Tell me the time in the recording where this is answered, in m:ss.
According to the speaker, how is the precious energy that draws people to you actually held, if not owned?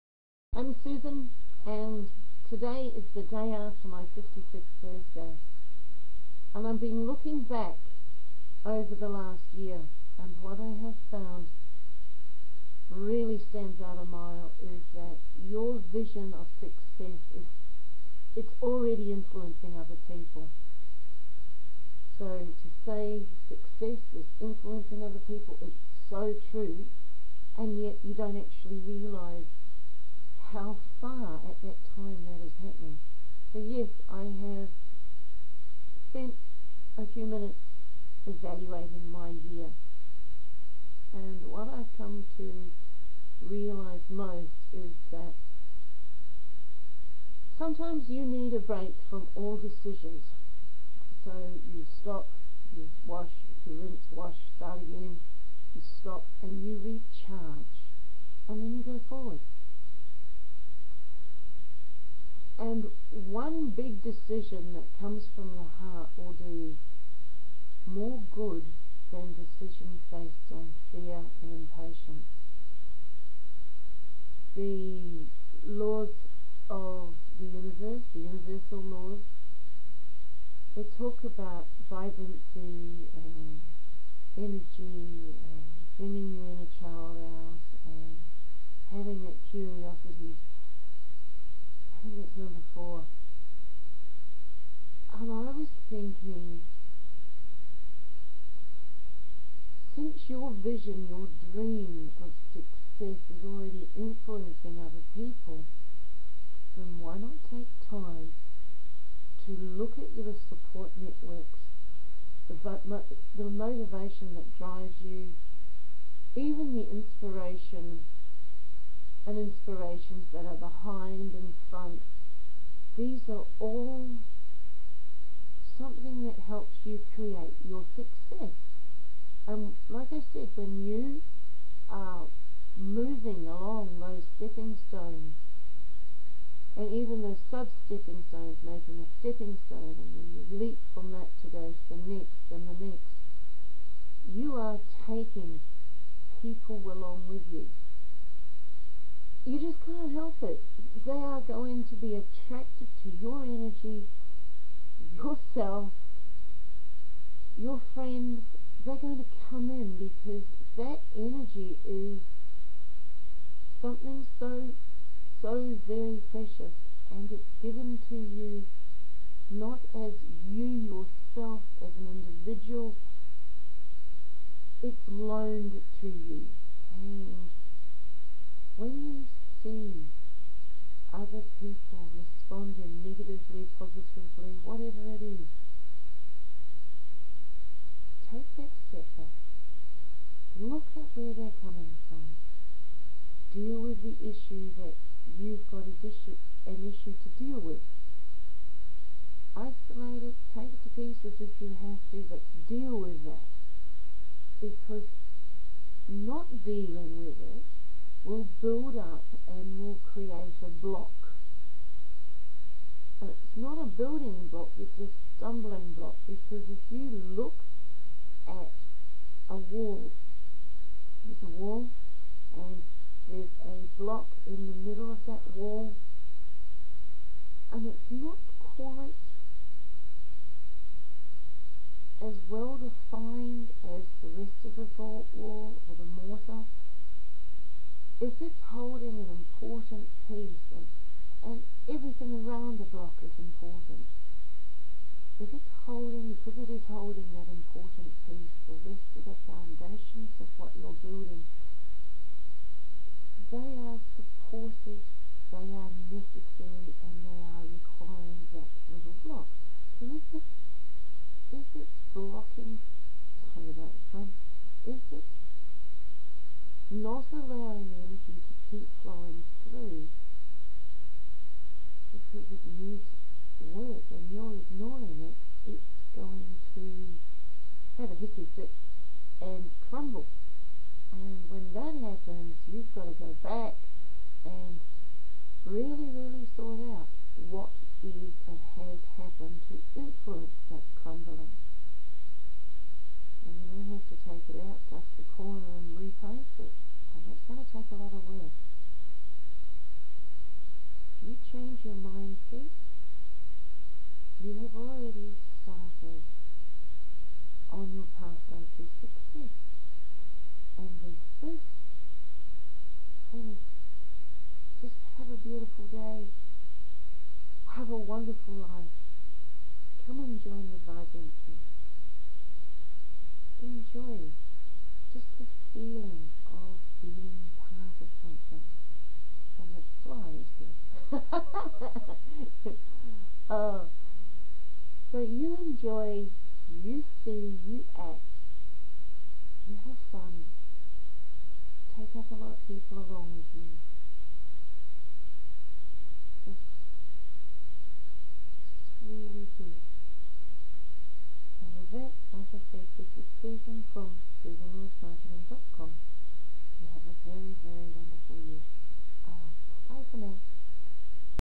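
2:55.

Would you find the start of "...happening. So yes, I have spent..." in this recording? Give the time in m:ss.
0:32.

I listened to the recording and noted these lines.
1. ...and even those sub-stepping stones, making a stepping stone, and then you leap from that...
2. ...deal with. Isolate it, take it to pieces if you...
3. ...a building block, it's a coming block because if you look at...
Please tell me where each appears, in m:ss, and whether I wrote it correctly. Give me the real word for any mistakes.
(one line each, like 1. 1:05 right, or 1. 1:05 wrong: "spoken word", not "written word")
1. 2:16 right
2. 3:17 right
3. 3:33 wrong: "stumbling", not "coming".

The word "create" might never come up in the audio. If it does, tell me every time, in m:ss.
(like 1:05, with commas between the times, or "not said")
2:07, 3:30.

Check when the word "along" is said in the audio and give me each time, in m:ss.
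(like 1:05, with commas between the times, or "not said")
2:13, 2:26, 5:43.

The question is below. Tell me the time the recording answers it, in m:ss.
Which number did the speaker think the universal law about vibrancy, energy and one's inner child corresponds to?
1:32.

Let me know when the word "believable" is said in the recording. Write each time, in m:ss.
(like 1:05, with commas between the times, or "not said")
not said.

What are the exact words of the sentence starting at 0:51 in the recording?
So you stop, you wash, you rinse, wash, start again, you stop, and you recharge.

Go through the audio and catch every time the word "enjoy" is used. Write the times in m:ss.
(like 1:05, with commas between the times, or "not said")
5:23, 5:35.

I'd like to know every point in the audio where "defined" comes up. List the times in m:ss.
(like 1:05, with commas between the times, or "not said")
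3:52.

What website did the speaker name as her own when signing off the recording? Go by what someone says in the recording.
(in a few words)
SusanLewisMarketing.com.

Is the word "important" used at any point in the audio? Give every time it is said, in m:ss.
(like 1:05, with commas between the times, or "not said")
3:59, 4:03, 4:07.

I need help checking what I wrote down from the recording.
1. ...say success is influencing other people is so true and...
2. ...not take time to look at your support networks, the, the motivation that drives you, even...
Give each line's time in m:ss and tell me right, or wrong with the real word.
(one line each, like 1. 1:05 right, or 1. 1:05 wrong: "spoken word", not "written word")
1. 0:22 right
2. 1:47 right.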